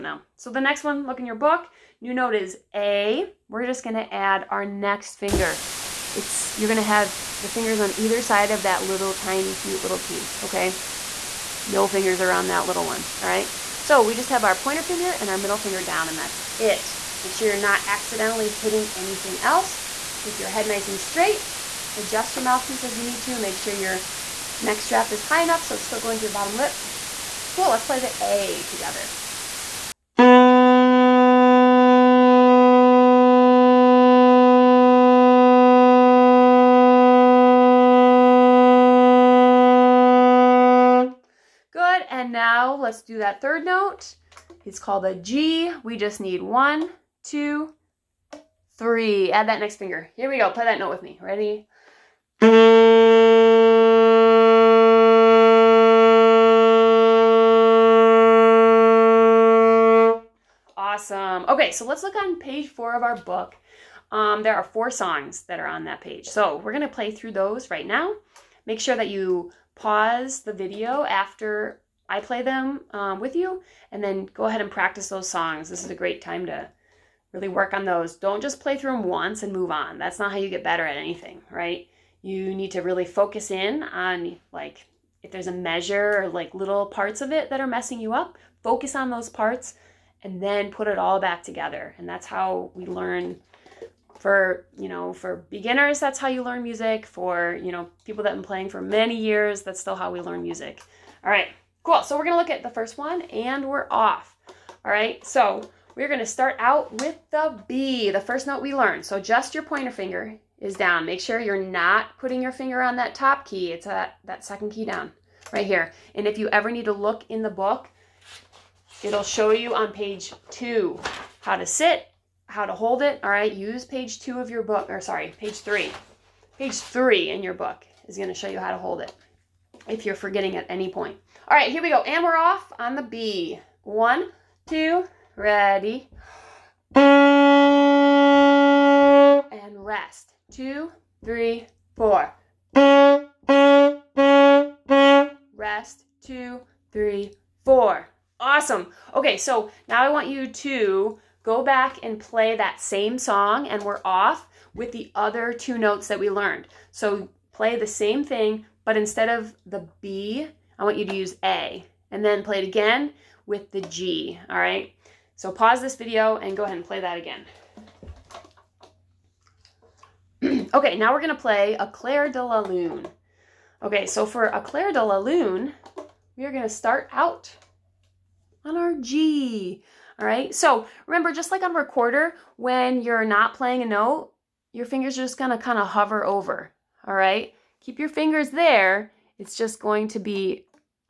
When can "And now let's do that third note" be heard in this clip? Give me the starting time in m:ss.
0:42.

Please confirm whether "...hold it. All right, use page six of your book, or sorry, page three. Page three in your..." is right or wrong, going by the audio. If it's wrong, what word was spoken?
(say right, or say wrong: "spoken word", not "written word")
wrong: "two", not "six".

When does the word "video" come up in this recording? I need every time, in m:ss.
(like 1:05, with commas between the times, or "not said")
1:10, 2:45.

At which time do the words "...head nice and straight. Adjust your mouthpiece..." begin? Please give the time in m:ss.
0:20.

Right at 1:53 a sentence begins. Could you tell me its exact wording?
It's a, that second key down right here.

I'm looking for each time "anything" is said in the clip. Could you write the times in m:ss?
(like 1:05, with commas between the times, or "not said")
0:18, 1:20.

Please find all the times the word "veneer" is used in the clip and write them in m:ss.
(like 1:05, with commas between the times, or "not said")
not said.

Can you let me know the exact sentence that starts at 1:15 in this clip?
This is a great time to really work on those.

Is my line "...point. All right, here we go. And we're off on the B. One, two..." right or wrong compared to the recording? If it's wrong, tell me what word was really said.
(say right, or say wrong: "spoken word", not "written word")
right.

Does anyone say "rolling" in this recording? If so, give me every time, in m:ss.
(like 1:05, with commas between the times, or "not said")
not said.